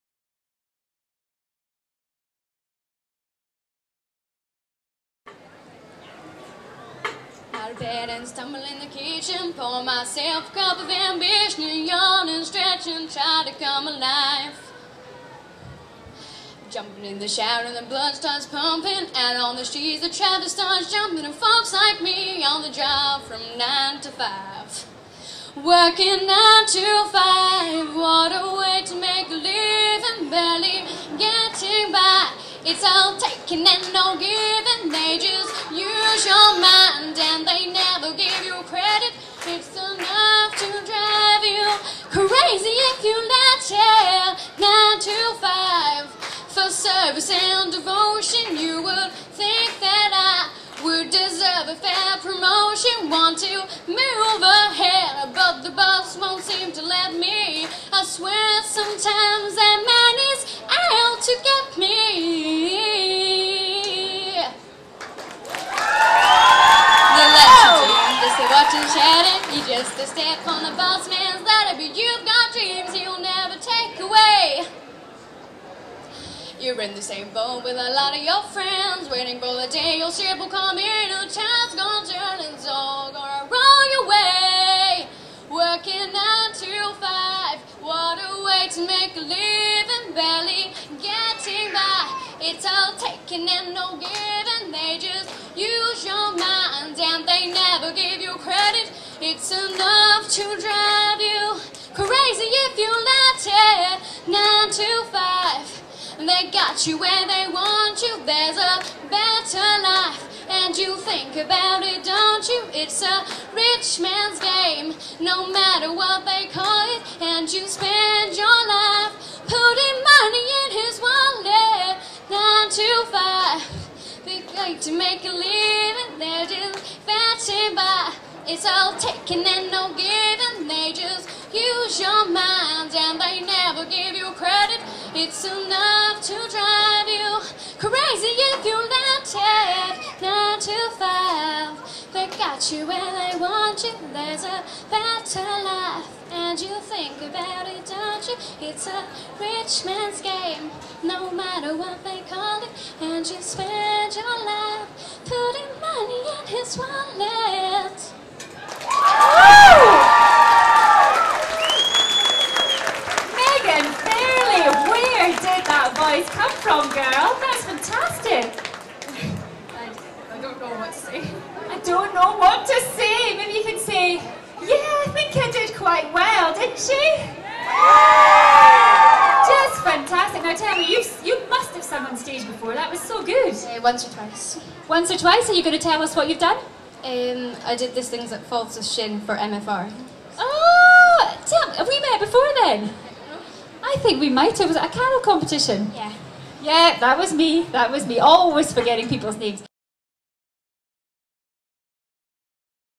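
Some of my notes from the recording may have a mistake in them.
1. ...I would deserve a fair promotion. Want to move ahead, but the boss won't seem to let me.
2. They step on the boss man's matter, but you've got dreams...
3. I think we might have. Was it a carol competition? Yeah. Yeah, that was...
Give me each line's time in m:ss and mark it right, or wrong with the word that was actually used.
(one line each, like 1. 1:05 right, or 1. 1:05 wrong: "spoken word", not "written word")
1. 0:50 right
2. 1:10 wrong: "ladder", not "matter"
3. 3:13 right.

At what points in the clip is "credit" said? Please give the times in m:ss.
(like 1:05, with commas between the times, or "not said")
0:38, 1:38, 2:14.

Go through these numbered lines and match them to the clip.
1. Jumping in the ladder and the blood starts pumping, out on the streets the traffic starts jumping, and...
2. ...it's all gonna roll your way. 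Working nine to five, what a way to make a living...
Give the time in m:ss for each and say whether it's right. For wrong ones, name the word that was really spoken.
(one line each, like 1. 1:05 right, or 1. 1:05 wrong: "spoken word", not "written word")
1. 0:16 wrong: "shower", not "ladder"
2. 1:22 right.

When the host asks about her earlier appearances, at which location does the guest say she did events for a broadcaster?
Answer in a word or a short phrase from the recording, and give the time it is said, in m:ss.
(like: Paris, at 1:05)
Falls of Shin, at 3:08.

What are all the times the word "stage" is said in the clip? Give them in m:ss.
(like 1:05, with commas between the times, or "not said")
3:02.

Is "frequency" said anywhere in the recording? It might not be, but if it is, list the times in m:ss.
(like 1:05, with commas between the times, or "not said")
not said.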